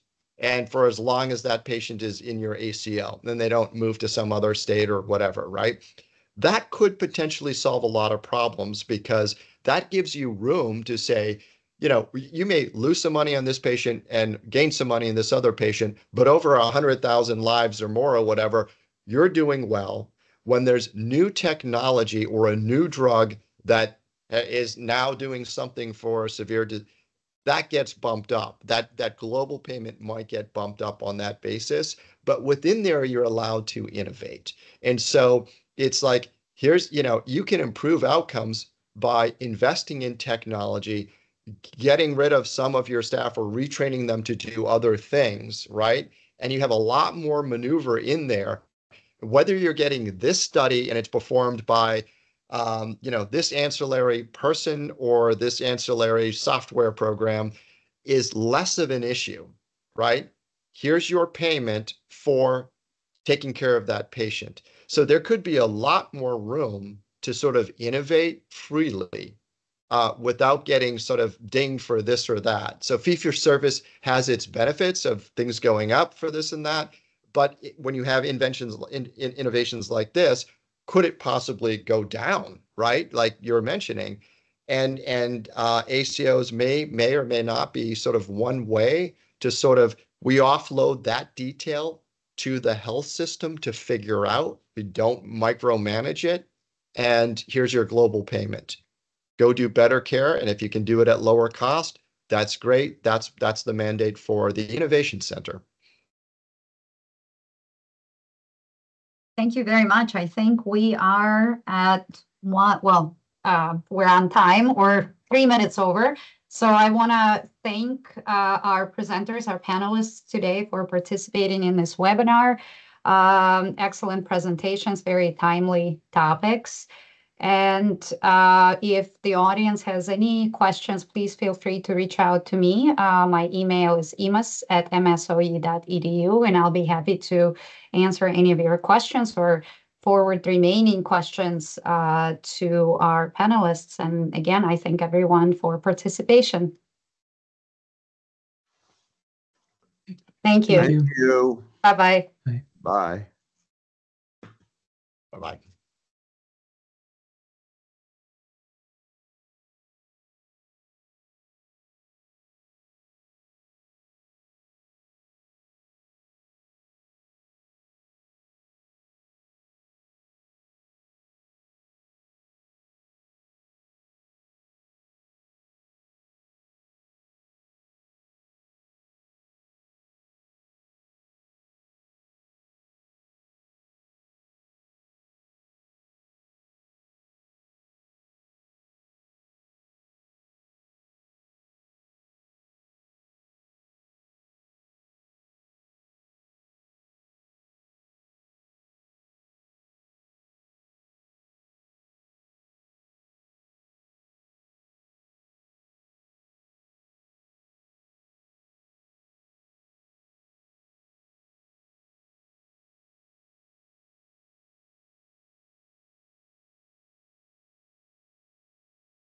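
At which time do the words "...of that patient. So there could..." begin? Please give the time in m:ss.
1:03.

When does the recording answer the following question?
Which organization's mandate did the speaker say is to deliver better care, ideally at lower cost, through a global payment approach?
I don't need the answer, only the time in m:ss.
1:44.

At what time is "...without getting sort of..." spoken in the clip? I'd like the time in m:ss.
1:10.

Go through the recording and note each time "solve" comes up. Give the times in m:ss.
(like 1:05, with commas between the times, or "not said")
0:07.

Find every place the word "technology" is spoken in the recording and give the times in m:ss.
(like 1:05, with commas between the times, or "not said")
0:21, 0:40.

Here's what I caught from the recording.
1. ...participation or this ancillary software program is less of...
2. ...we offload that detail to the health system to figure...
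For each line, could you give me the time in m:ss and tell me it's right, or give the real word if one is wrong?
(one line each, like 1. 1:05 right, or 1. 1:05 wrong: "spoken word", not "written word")
1. 0:54 wrong: "person", not "participation"
2. 1:30 right.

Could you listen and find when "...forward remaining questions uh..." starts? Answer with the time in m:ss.
2:20.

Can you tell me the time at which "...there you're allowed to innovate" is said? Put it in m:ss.
0:32.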